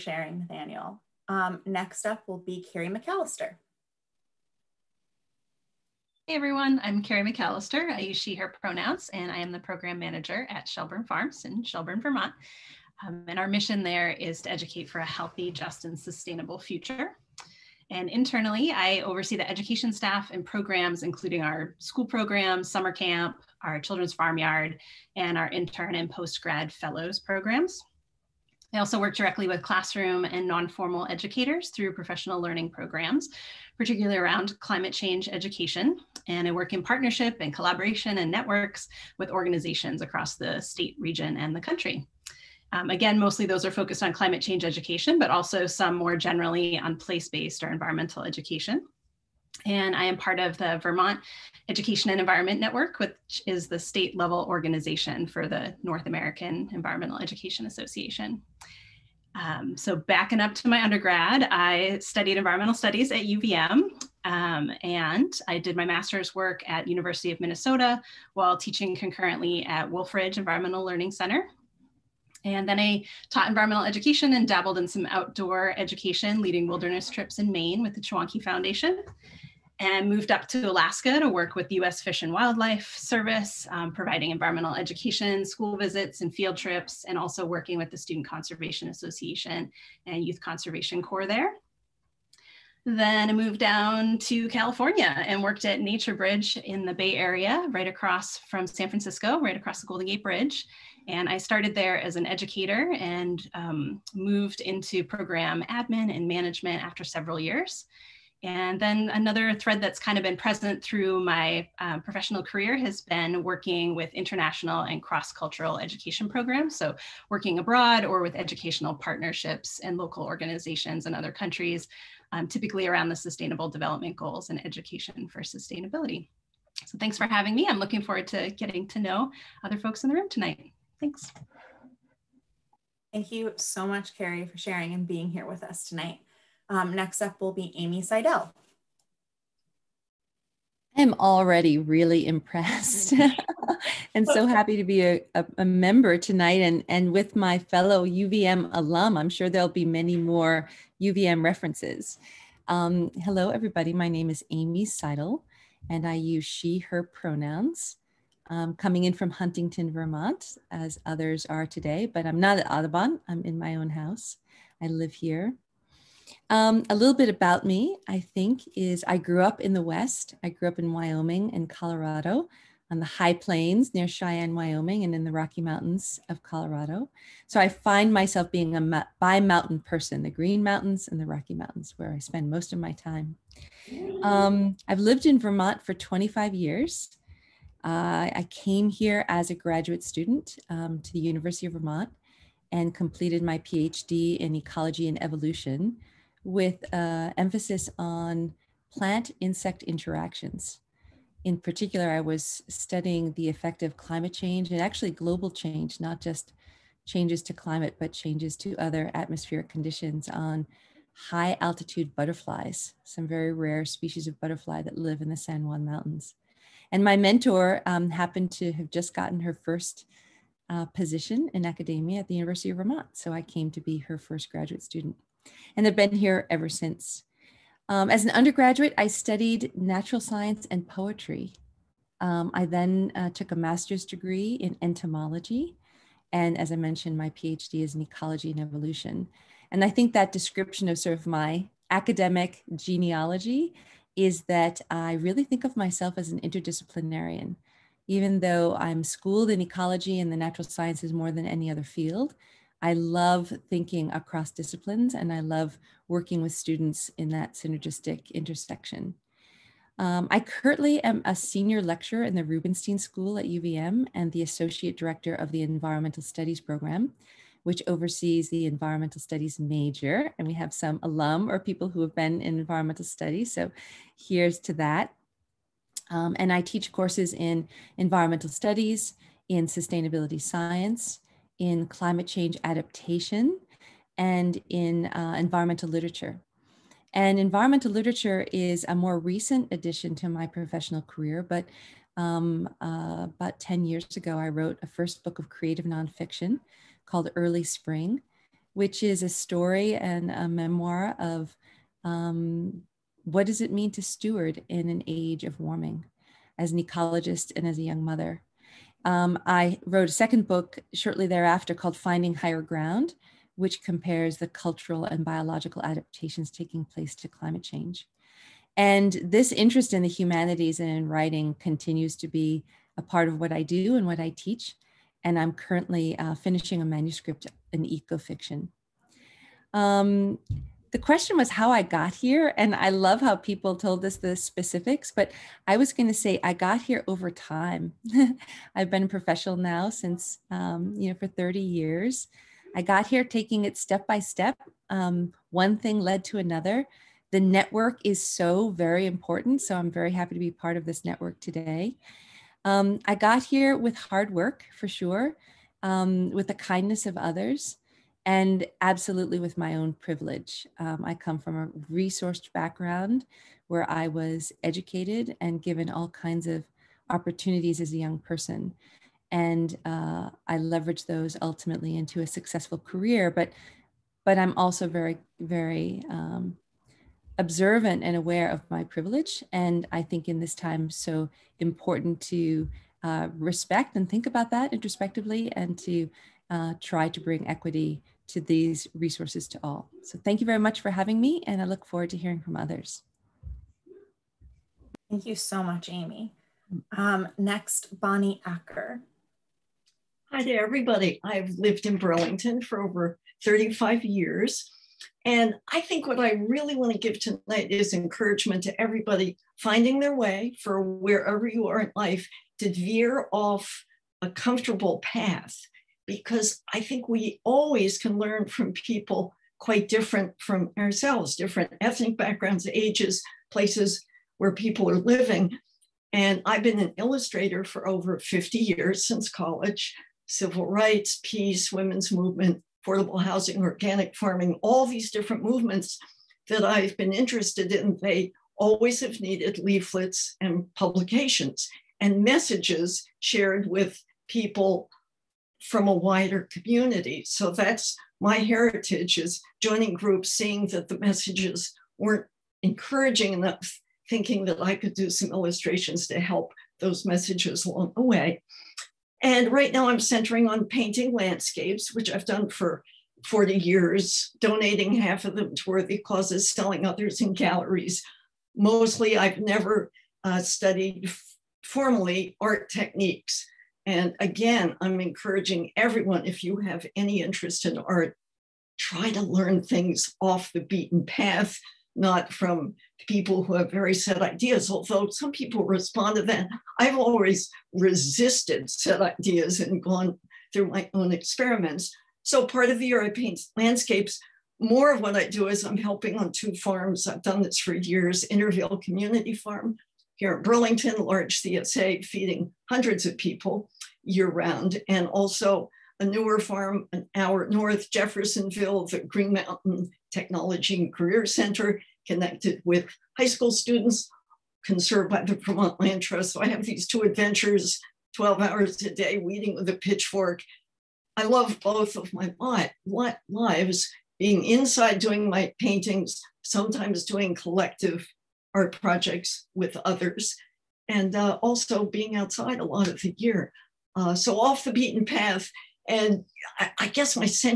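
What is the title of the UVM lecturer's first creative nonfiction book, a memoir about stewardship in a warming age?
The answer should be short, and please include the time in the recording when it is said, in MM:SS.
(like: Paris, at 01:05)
Early Spring, at 04:57.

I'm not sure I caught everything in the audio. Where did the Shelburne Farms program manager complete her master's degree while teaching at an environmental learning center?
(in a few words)
University of Minnesota.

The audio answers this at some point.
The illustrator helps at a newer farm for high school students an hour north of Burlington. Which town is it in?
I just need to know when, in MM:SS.
08:27.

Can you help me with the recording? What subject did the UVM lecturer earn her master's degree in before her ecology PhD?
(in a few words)
Entomology.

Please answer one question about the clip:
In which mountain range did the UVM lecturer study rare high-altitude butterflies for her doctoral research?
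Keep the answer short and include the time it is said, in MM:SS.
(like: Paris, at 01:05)
San Juan Mountains, at 03:35.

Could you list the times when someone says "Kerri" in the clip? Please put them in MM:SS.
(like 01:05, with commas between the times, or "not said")
00:02, 00:07, 02:14.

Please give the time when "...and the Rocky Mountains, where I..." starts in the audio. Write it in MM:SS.
03:01.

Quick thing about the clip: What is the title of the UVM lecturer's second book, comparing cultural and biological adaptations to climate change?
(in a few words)
Finding Higher Ground.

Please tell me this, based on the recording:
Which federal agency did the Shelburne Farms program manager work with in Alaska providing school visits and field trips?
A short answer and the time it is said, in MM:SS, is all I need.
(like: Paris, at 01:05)
US Fish and Wildlife Service, at 01:21.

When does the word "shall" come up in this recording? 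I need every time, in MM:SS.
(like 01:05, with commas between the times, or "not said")
not said.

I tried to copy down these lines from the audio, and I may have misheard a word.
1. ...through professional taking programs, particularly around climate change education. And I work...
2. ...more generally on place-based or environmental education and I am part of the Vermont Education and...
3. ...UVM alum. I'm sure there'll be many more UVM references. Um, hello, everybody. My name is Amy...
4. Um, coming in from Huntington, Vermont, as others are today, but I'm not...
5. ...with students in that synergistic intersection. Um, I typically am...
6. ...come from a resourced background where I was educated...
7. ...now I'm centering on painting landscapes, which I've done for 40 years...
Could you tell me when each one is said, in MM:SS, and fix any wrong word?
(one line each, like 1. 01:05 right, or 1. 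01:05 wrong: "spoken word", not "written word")
1. 00:31 wrong: "learning", not "taking"
2. 00:45 right
3. 02:28 right
4. 02:38 right
5. 04:16 wrong: "currently", not "typically"
6. 06:01 right
7. 07:39 right.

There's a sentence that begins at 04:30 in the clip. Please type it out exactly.
And we have some alum or people who have been in environmental studies.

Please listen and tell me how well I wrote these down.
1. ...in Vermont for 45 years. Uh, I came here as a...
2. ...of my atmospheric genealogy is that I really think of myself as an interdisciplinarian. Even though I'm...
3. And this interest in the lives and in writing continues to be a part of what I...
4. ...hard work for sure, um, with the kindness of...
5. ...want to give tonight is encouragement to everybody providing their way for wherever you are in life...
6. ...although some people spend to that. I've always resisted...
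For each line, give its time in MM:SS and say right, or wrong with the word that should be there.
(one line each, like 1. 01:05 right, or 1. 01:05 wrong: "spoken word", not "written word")
1. 03:05 wrong: "25", not "45"
2. 04:01 wrong: "academic", not "atmospheric"
3. 05:18 wrong: "humanities", not "lives"
4. 05:53 right
5. 06:46 wrong: "finding", not "providing"
6. 08:04 wrong: "respond", not "spend".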